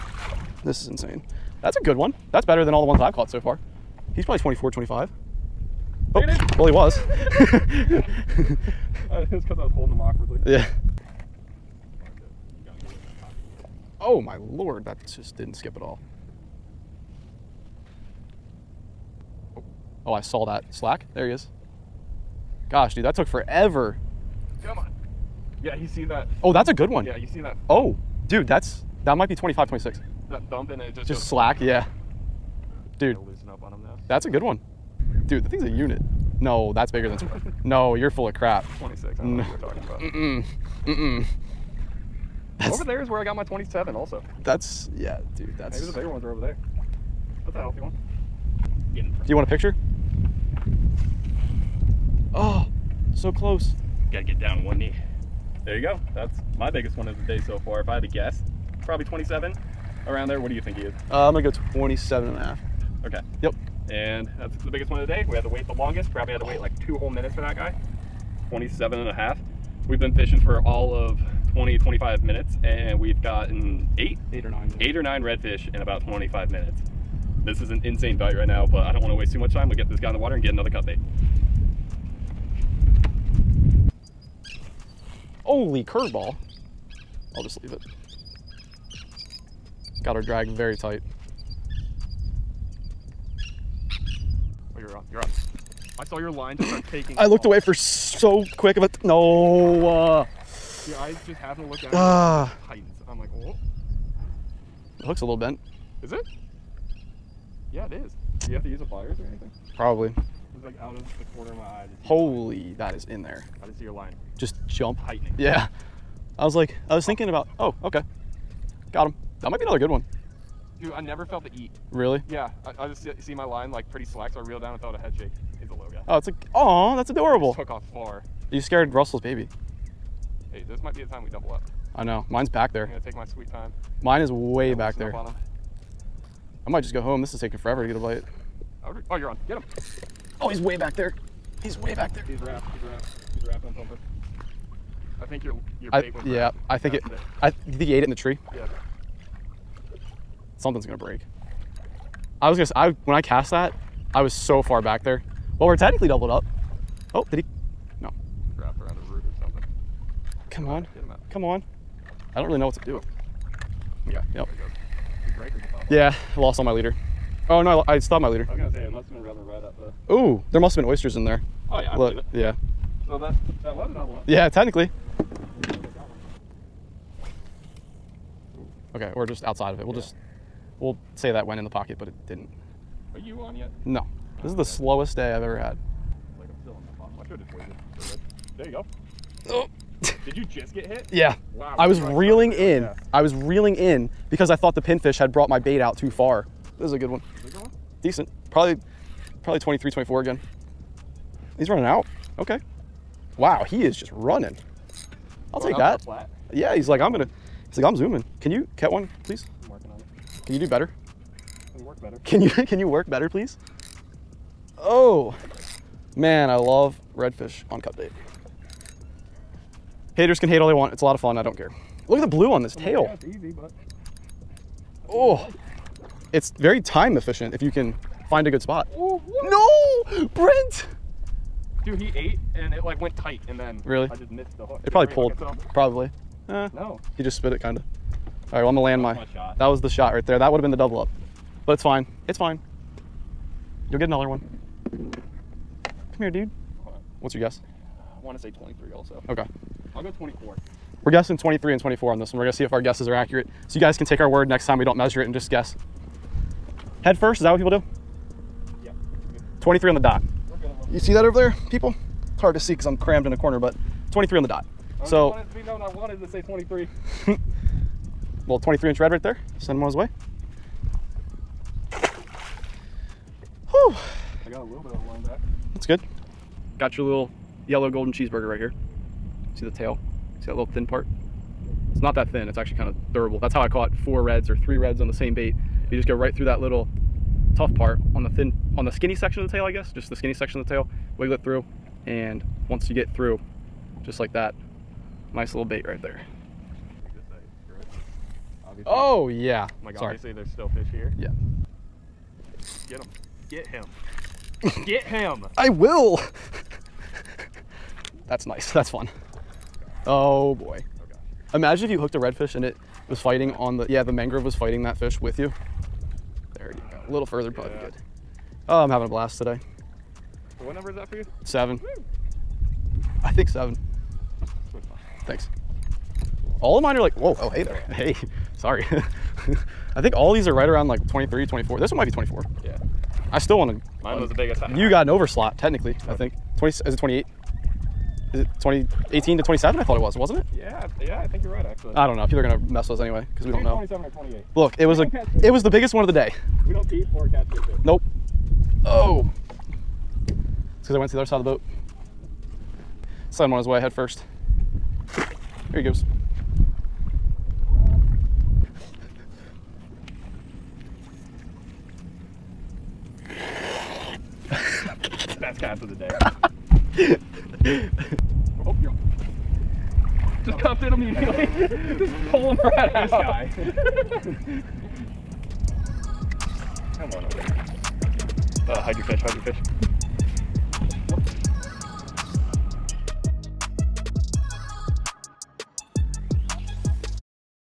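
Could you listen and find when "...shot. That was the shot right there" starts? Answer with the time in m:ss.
3:59.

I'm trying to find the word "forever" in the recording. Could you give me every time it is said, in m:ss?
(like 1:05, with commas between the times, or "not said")
0:23, 2:17.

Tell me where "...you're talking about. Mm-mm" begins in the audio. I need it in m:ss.
0:39.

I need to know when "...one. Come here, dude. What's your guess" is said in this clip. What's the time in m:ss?
4:04.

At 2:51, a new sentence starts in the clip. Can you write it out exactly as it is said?
Oh yeah, I Look, believe it.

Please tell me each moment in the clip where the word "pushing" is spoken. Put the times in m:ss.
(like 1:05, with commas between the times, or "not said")
not said.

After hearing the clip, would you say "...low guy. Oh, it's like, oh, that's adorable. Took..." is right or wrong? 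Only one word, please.
right.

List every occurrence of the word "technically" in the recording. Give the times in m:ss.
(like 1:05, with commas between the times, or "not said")
2:35, 2:54, 5:35.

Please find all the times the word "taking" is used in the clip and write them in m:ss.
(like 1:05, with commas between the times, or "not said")
1:36, 2:17.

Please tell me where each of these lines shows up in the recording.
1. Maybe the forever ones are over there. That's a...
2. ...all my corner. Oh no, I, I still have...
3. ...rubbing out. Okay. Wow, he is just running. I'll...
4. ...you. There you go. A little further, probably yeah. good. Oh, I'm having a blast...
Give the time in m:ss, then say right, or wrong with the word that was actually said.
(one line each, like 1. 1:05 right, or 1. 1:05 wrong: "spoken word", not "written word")
1. 0:45 wrong: "bigger", not "forever"
2. 2:46 wrong: "leader", not "corner"
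3. 3:21 wrong: "running", not "rubbing"
4. 5:15 right.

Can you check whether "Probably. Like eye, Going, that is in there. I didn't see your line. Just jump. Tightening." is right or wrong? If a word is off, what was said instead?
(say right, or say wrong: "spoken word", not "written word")
wrong: "Holy", not "Going".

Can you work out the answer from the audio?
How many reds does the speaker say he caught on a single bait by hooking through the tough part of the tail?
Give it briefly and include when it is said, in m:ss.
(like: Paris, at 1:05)
3, at 4:44.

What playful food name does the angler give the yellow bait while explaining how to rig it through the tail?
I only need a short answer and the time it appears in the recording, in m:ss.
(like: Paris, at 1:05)
golden cheeseburger, at 4:37.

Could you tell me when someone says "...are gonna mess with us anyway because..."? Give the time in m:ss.
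5:42.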